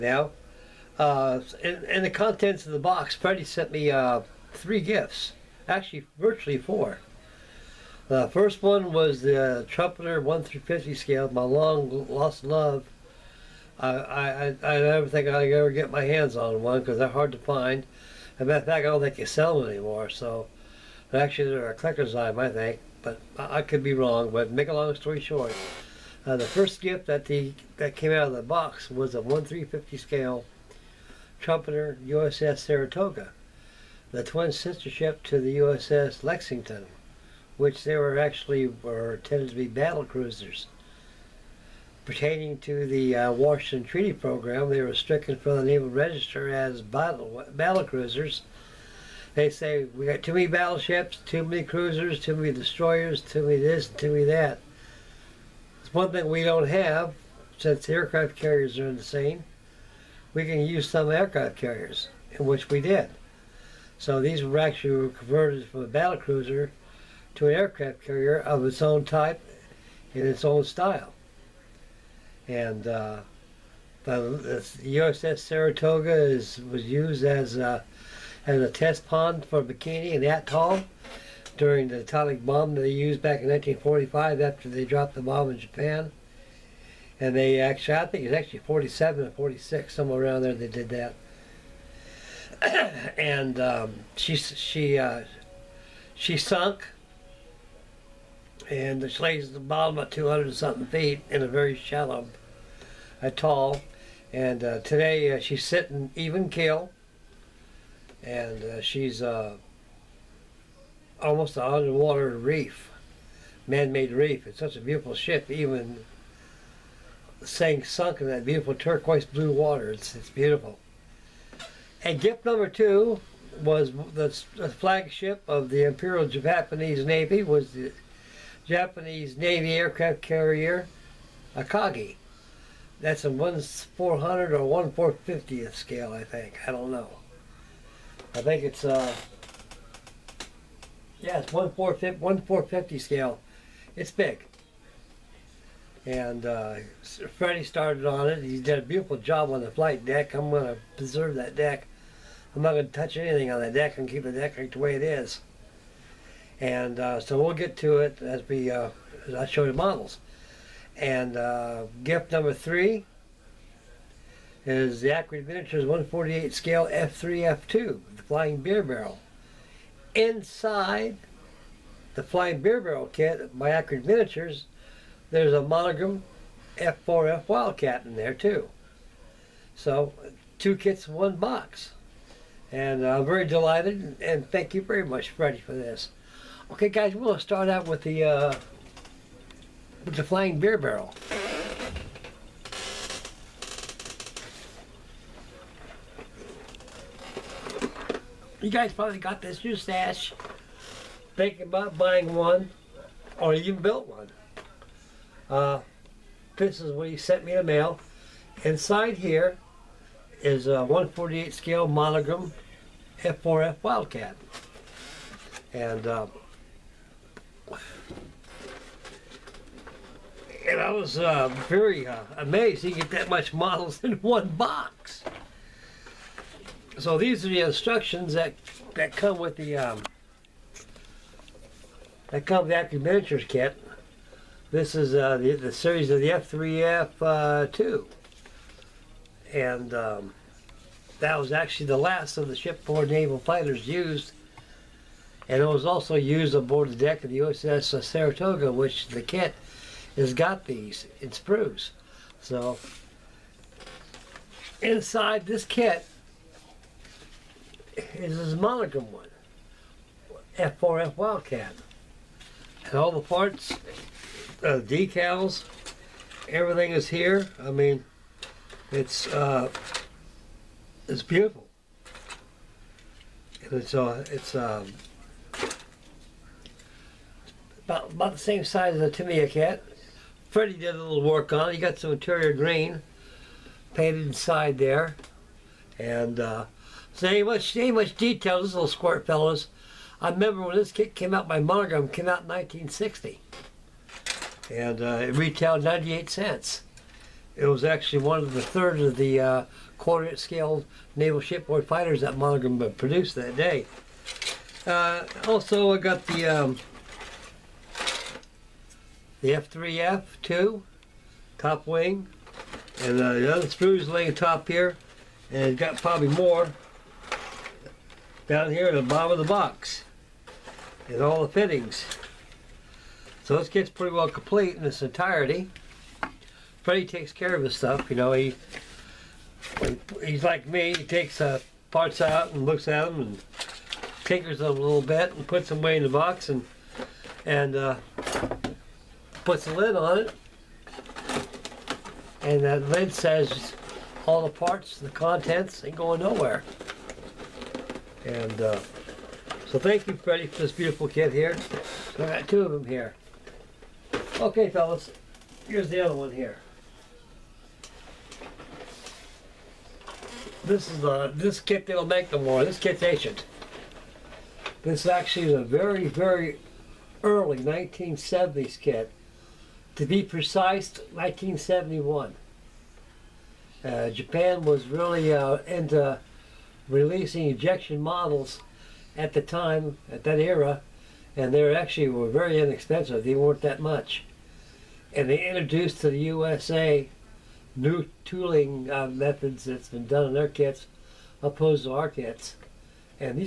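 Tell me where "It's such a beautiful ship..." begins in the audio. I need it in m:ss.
1:54.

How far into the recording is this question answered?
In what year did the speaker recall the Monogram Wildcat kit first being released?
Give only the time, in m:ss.
4:52.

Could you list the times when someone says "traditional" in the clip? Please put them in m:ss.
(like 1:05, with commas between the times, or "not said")
not said.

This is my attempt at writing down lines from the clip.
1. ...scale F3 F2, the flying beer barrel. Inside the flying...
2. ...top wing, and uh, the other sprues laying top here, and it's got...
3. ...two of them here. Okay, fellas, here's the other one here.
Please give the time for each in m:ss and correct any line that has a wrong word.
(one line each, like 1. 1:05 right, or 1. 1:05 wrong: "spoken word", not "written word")
1. 2:46 right
2. 5:11 right
3. 5:52 right.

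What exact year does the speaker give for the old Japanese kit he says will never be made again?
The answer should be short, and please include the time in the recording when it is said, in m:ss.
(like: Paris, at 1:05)
1971, at 6:11.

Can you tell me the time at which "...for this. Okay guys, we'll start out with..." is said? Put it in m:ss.
3:05.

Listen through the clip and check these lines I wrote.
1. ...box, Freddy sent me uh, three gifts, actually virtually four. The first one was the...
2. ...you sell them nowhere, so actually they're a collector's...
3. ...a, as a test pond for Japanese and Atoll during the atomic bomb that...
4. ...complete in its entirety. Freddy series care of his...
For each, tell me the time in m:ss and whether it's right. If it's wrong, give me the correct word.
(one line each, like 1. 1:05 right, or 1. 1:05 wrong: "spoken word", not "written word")
1. 0:02 right
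2. 0:19 wrong: "anymore", not "nowhere"
3. 1:17 wrong: "Bikini", not "Japanese"
4. 5:24 wrong: "takes", not "series".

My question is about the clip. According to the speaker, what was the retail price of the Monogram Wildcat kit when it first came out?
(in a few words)
98 cents.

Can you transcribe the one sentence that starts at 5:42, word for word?
And that lid says all the parts, the contents ain't going nowhere.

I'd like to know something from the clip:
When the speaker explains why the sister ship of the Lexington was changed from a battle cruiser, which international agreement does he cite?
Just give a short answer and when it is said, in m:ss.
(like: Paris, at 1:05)
Washington Treaty, at 0:43.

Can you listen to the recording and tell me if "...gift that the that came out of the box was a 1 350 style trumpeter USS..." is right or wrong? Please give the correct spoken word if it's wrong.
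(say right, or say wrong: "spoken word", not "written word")
wrong: "scale", not "style".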